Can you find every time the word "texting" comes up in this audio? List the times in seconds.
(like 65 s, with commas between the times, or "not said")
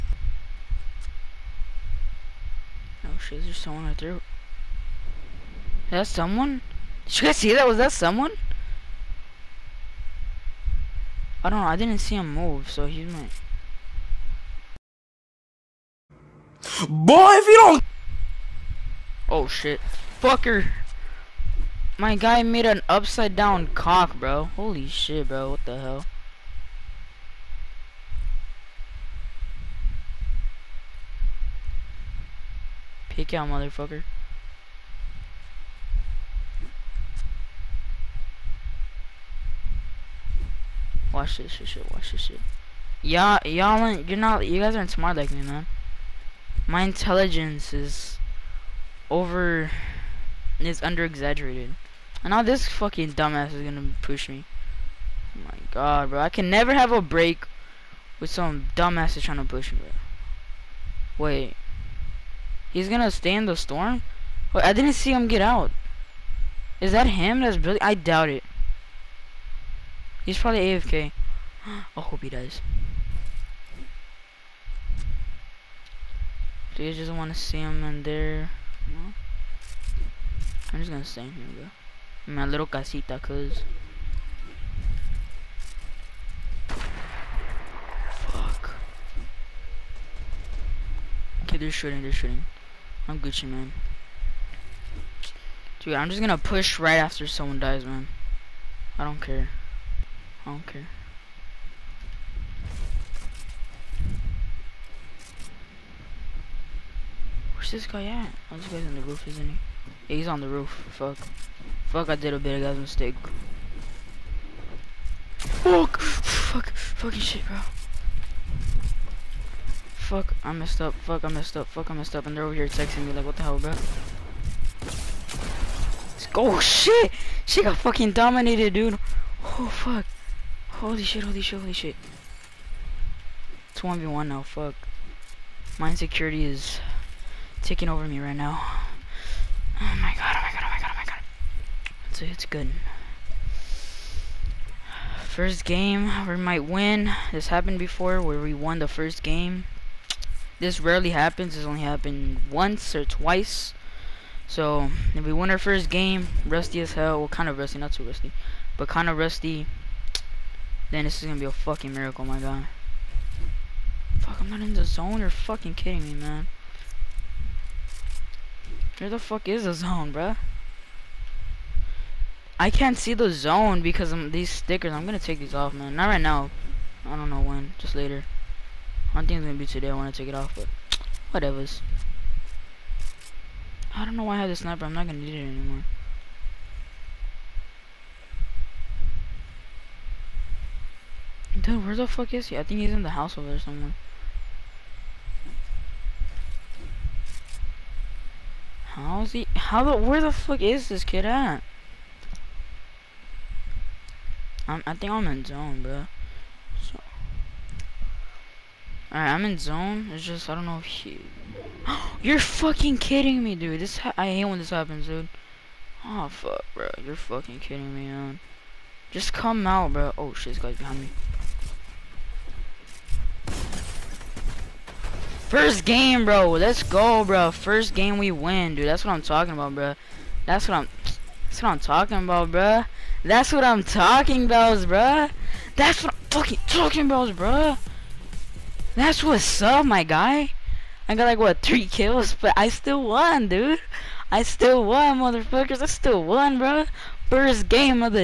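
122 s.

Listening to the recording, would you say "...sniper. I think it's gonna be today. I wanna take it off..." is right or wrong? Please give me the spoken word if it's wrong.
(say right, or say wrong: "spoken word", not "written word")
wrong: "later", not "sniper".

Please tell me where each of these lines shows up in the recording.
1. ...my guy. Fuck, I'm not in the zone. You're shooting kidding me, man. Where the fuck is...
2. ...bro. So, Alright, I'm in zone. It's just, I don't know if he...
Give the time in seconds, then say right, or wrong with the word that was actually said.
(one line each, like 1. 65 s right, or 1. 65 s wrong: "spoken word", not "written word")
1. 162 s wrong: "fucking", not "shooting"
2. 205 s right.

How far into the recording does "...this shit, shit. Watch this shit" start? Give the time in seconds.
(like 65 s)
41 s.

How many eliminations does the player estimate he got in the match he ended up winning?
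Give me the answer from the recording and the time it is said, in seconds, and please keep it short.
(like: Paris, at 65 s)
3, at 241 s.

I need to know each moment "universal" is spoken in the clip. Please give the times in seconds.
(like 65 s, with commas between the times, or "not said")
not said.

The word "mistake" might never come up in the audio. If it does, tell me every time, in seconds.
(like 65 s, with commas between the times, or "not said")
112 s.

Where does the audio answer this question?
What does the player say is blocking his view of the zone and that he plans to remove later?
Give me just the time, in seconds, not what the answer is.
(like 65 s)
174 s.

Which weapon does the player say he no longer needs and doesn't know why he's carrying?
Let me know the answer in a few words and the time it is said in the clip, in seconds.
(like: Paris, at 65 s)
sniper, at 184 s.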